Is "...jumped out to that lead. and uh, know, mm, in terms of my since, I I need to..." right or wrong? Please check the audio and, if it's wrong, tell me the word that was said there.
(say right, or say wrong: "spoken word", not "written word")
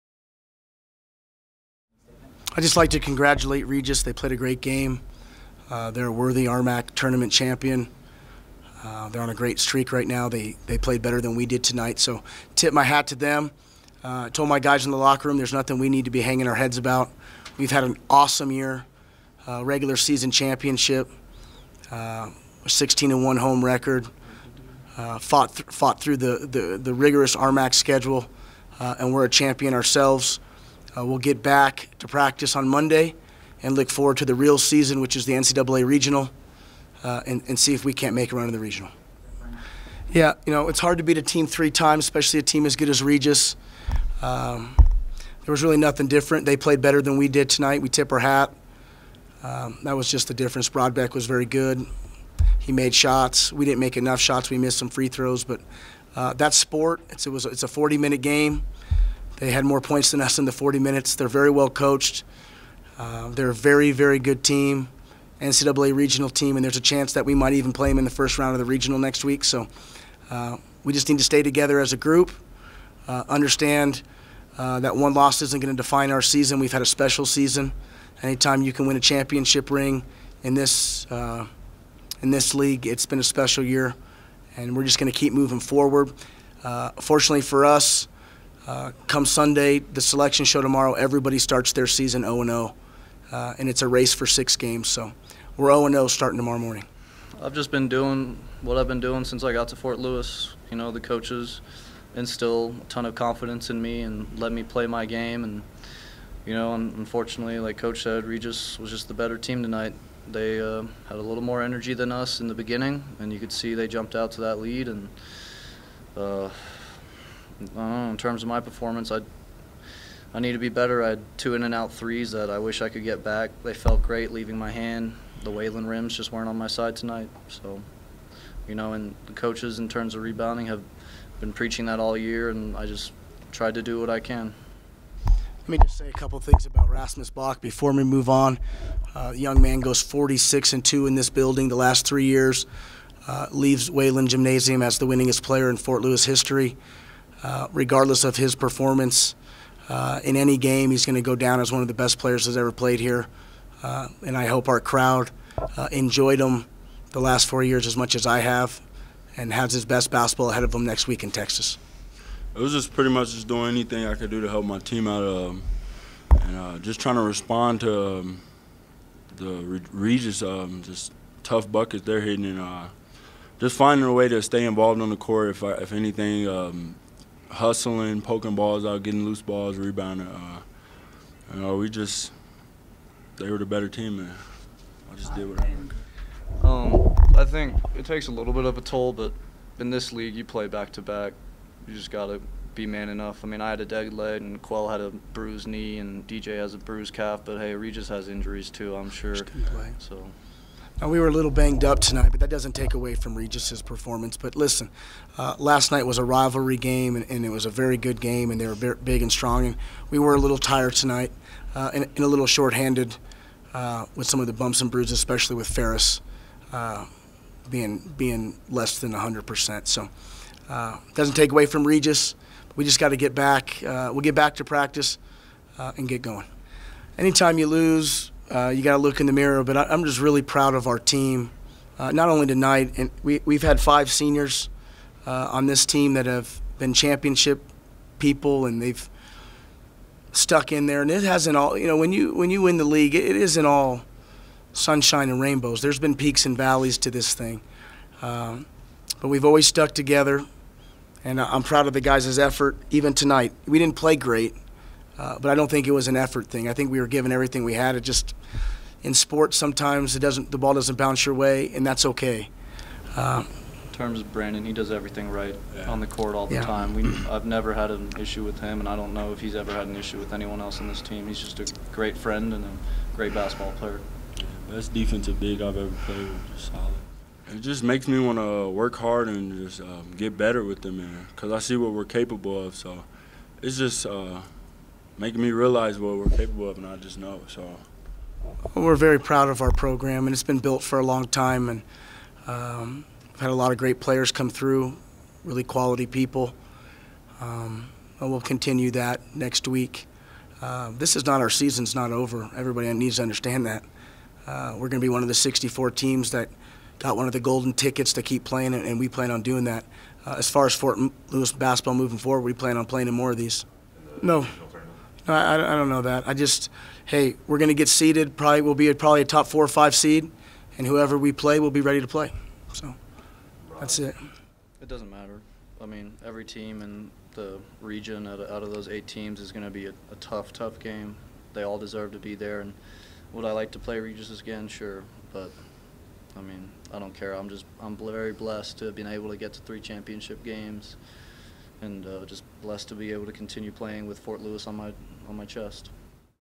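wrong: "performance", not "since".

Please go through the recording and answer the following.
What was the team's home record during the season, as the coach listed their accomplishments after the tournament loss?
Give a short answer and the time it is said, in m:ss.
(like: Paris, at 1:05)
16-1, at 0:22.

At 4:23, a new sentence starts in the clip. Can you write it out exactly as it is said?
Uh, in terms of Brandon, he does everything right yeah.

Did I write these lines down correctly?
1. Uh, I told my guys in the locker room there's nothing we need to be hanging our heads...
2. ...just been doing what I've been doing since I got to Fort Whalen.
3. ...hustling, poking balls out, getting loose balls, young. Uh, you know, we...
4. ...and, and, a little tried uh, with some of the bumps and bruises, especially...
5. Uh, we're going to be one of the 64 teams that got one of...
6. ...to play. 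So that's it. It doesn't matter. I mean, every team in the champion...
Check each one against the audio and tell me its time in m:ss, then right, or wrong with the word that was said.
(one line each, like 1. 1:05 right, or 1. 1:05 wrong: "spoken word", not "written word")
1. 0:14 right
2. 1:37 wrong: "Lewis", not "Whalen"
3. 2:57 wrong: "rebounding", not "young"
4. 3:31 wrong: "shorthanded", not "tried"
5. 5:04 right
6. 5:22 wrong: "region", not "champion".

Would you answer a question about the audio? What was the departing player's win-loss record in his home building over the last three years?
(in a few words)
46-2.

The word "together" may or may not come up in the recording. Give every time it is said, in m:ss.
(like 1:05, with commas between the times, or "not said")
1:11, 4:09.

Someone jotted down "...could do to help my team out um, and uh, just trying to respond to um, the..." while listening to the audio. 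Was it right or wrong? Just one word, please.
right.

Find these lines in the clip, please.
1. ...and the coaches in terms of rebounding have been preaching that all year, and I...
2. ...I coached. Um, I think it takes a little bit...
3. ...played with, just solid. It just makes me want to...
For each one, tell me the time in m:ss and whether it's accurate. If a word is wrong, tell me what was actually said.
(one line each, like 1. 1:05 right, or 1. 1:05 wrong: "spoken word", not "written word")
1. 2:08 right
2. 3:05 wrong: "wanted", not "coached"
3. 4:36 right.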